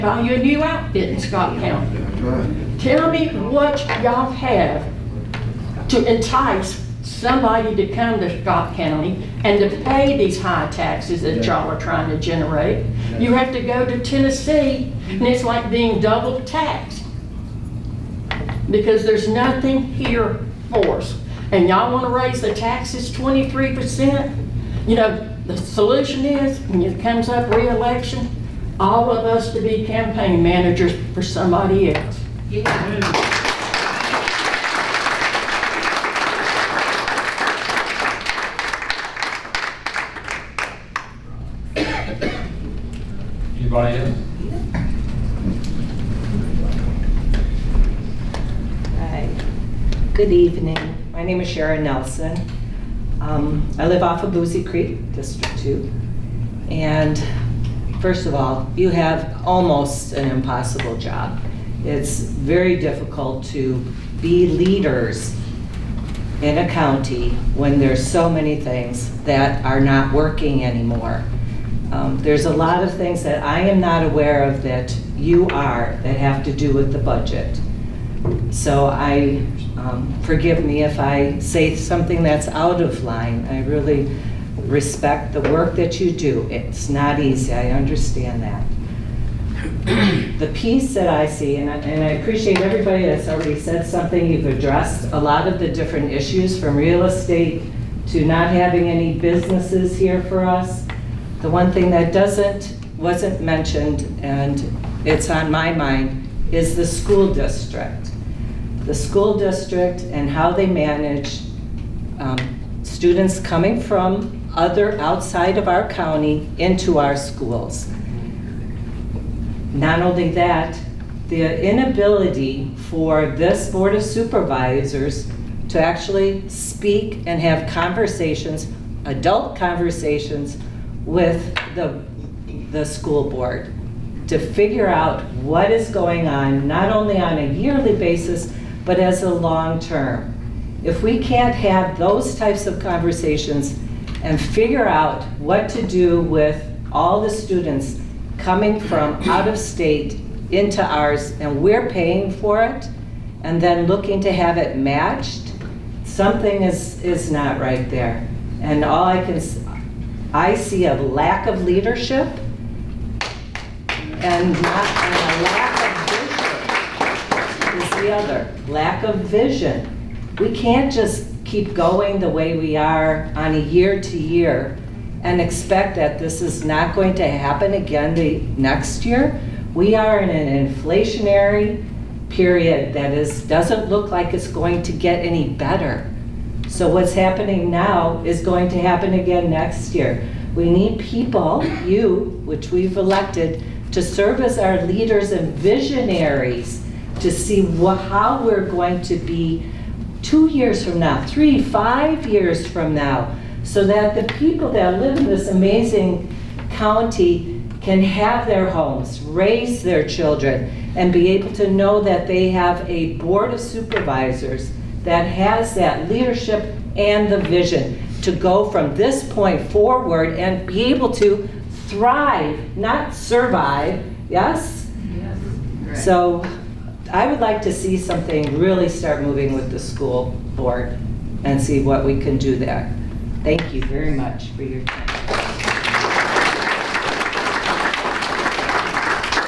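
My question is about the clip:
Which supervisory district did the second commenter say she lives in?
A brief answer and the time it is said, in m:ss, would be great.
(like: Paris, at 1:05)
District 2, at 0:55.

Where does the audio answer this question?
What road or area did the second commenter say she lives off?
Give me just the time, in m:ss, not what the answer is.
0:54.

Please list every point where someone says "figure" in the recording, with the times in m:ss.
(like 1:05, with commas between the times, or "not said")
2:14, 2:24.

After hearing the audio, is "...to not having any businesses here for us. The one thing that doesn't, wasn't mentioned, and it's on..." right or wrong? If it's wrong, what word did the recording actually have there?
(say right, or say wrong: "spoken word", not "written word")
right.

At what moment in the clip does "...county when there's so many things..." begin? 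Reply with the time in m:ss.
1:06.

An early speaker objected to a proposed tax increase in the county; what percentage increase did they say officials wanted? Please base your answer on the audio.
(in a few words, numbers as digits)
23%.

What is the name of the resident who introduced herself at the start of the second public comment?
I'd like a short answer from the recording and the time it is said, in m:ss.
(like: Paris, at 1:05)
Sharon Nelson, at 0:51.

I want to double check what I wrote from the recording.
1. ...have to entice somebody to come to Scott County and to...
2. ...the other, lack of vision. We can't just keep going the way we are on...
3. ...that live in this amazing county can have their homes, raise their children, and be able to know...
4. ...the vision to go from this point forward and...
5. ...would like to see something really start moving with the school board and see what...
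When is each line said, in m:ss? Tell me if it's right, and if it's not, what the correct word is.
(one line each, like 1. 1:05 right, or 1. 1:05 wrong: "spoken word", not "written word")
1. 0:04 right
2. 2:48 right
3. 3:24 right
4. 3:37 right
5. 3:47 right.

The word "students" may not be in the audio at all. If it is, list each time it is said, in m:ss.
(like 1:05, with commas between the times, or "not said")
1:52, 2:27.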